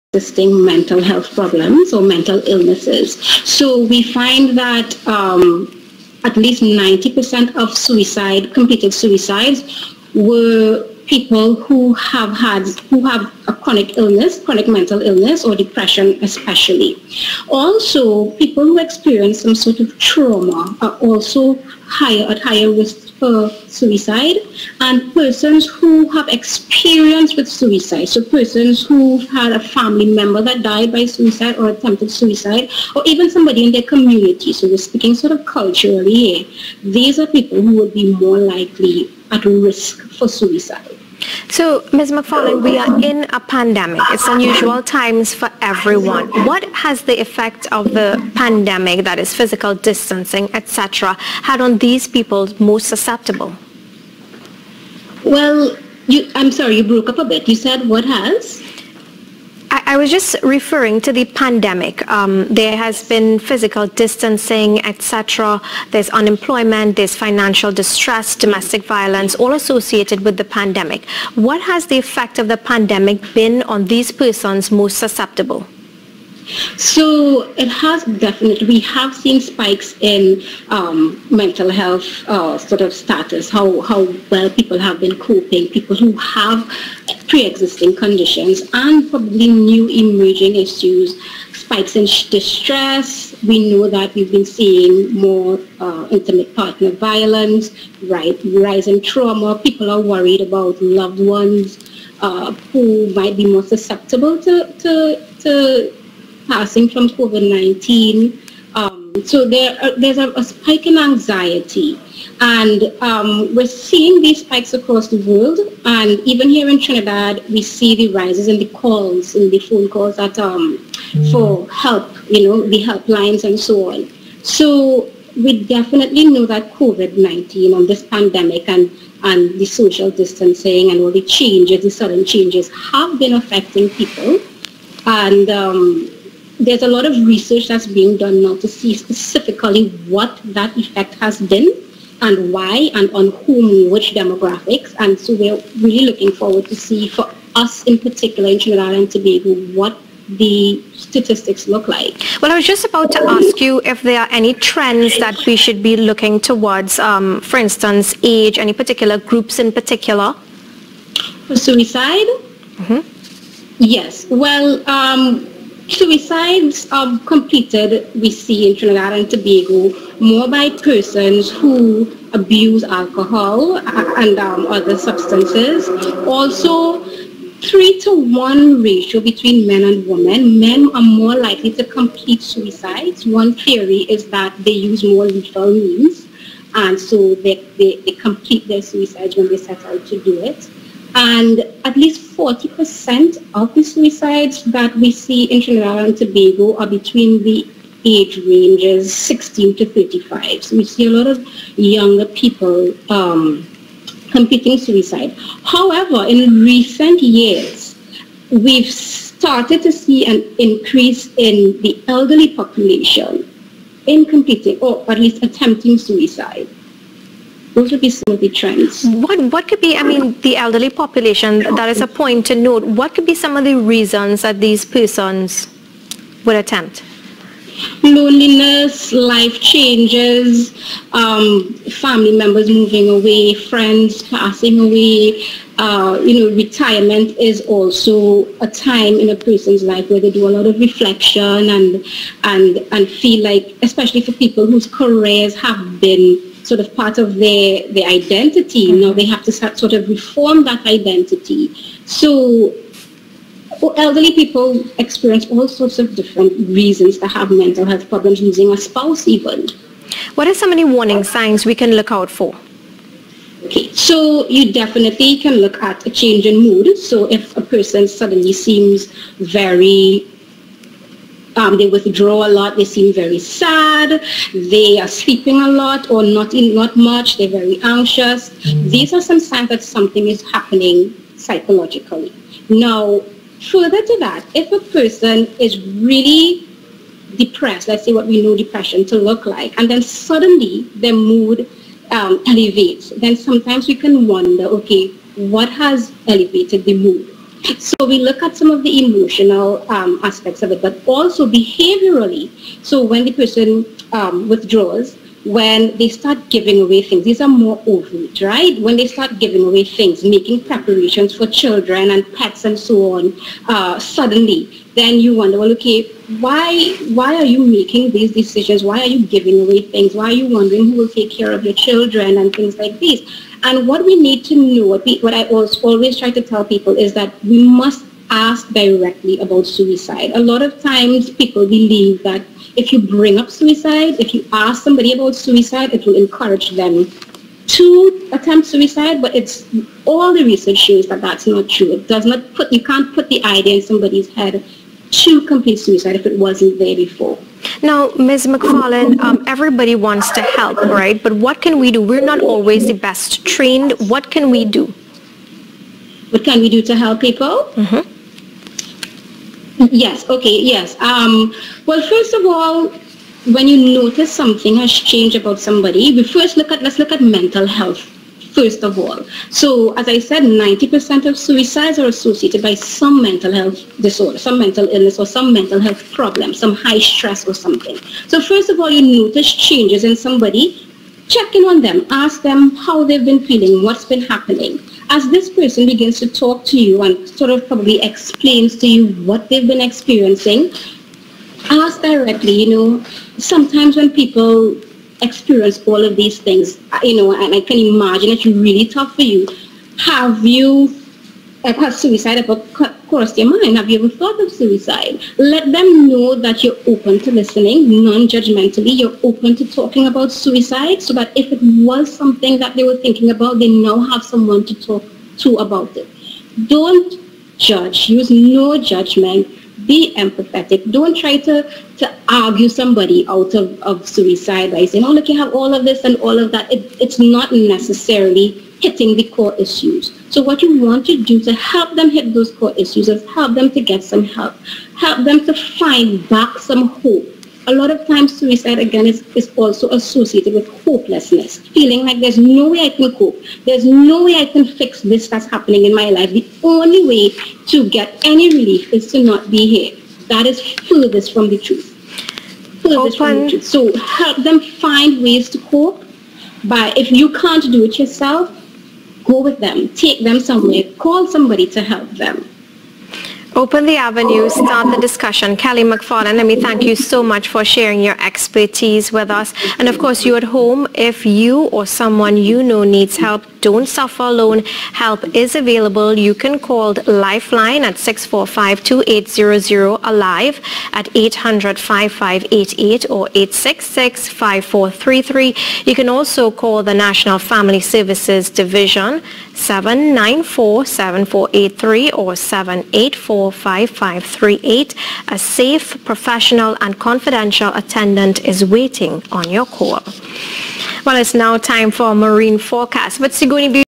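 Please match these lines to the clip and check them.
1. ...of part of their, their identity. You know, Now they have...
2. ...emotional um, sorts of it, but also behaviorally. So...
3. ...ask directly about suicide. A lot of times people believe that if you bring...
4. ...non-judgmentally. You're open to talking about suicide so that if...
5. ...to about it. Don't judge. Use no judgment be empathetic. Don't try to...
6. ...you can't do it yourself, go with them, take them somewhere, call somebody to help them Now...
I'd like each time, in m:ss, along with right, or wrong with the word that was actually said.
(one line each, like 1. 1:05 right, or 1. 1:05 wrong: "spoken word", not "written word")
1. 4:06 right
2. 4:59 wrong: "aspects", not "sorts"
3. 5:28 right
4. 6:48 right
5. 6:55 right
6. 7:37 wrong: "Open", not "Now".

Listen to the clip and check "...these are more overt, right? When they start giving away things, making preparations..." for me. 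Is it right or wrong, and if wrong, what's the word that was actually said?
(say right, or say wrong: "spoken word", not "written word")
right.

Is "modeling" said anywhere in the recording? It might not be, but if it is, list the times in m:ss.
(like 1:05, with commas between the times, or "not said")
not said.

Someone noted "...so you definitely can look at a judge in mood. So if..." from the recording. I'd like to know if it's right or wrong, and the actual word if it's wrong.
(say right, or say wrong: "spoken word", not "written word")
wrong: "change", not "judge".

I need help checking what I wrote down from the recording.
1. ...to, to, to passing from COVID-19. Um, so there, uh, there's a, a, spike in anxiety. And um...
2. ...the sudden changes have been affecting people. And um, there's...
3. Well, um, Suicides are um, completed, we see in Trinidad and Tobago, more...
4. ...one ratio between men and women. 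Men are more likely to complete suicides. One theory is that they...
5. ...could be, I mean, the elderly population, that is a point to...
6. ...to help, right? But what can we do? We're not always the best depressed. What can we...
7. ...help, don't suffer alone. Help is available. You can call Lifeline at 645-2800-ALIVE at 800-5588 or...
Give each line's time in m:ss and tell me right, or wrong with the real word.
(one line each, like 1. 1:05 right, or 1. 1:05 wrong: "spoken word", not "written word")
1. 1:44 right
2. 2:11 right
3. 2:44 right
4. 2:58 right
5. 3:39 right
6. 5:50 wrong: "trained", not "depressed"
7. 7:53 right.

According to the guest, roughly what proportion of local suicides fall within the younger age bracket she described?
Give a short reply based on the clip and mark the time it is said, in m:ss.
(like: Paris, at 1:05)
40%, at 3:11.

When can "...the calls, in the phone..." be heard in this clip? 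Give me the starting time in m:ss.
1:58.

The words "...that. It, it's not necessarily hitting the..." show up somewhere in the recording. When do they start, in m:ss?
7:06.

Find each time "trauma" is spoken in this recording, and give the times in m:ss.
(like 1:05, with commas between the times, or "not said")
0:19, 1:39.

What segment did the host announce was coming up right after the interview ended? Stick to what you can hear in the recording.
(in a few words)
Marine forecast.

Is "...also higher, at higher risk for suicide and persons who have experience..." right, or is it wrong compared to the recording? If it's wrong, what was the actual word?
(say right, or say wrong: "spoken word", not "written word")
right.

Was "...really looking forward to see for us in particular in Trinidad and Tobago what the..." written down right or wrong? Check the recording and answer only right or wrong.
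right.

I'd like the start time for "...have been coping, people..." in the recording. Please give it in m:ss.
1:24.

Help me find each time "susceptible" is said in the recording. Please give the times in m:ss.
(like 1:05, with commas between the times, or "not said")
0:52, 1:14, 1:43.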